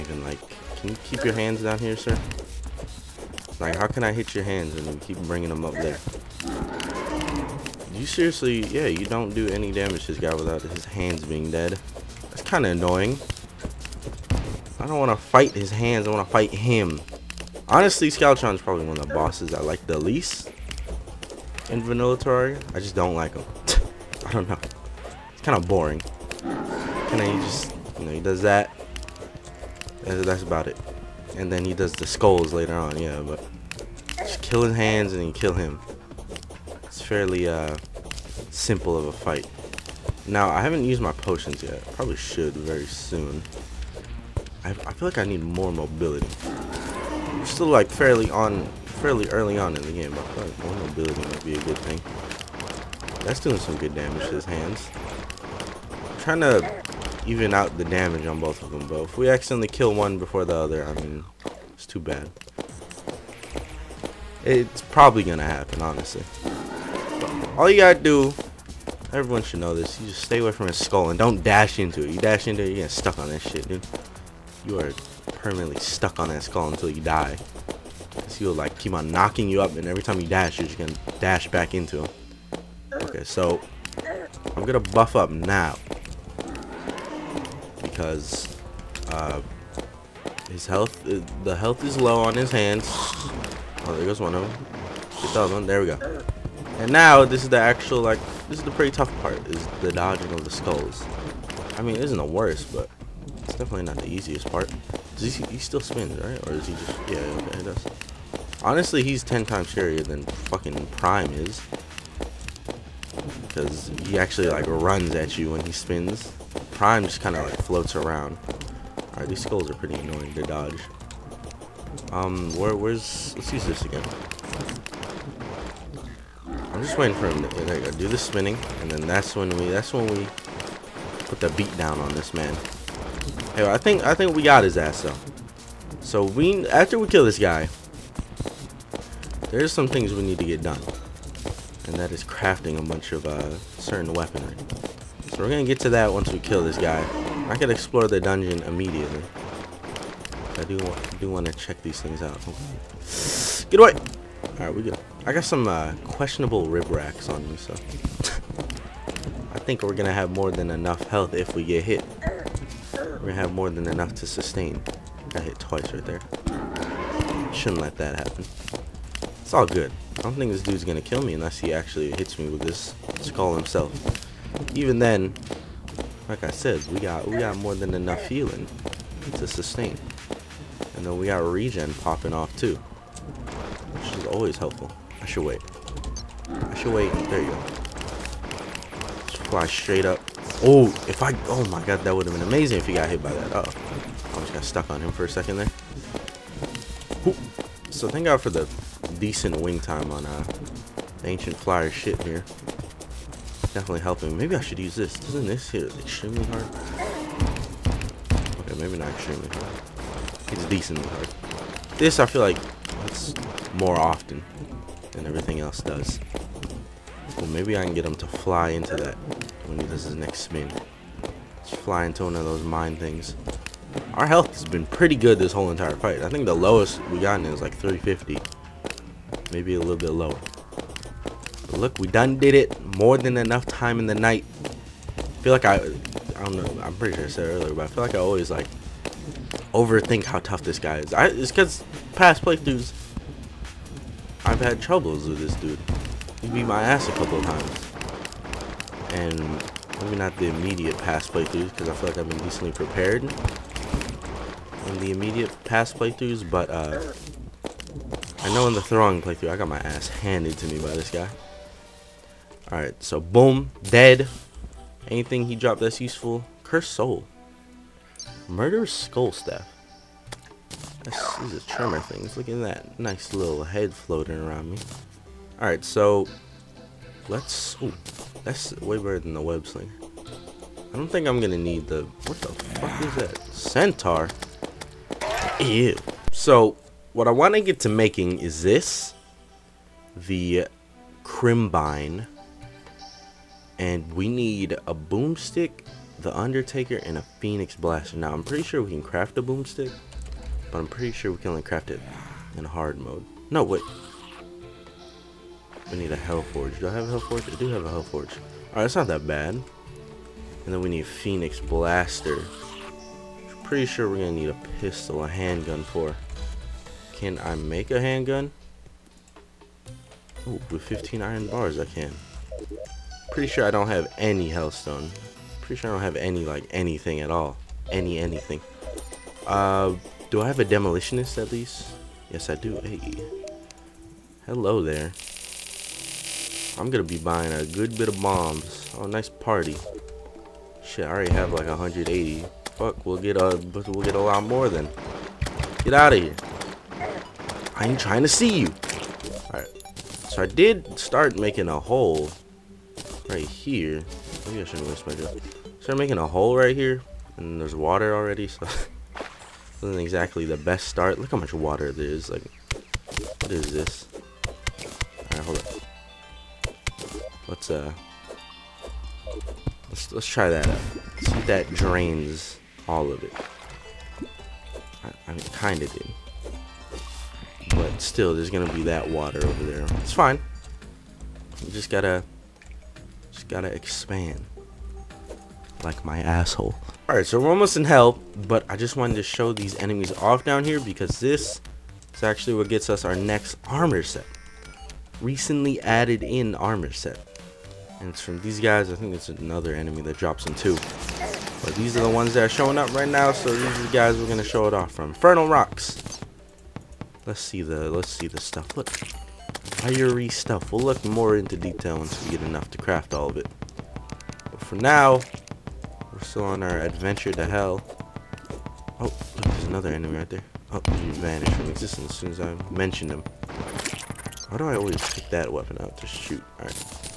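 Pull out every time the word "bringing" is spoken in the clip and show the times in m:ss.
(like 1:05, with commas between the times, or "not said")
0:05.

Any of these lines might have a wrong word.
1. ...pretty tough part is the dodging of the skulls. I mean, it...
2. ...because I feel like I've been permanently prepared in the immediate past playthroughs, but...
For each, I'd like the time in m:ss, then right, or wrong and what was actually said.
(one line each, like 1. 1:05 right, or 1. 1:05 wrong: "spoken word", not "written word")
1. 1:38 right
2. 4:11 wrong: "decently", not "permanently".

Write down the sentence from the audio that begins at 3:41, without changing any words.
Let's fly into one of those mine things.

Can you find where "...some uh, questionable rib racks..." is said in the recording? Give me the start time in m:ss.
2:35.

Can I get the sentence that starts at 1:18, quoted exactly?
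Because he'll like keep on knocking you up and every time you dash, you're just gonna dash back into him.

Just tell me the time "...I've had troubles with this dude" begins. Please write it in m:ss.
4:04.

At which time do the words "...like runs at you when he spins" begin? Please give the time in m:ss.
1:54.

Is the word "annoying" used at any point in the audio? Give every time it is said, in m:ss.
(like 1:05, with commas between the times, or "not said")
0:12, 1:59.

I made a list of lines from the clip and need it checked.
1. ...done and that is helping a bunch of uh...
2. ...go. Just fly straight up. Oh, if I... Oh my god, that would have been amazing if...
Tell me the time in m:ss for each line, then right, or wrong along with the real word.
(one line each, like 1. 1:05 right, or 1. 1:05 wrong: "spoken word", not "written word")
1. 2:20 wrong: "crafting", not "helping"
2. 3:07 right.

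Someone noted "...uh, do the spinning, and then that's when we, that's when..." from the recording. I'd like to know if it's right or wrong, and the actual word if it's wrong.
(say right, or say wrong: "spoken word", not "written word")
right.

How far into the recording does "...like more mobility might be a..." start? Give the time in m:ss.
0:50.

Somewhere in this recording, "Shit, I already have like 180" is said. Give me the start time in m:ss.
5:40.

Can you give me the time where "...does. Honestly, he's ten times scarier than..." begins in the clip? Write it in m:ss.
1:47.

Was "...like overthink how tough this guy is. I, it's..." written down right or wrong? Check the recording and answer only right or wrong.
right.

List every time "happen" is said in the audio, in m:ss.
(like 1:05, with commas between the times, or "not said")
1:05, 2:48.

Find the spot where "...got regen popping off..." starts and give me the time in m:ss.
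3:01.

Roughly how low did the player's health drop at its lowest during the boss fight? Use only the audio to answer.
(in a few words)
350.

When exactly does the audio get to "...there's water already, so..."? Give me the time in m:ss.
5:57.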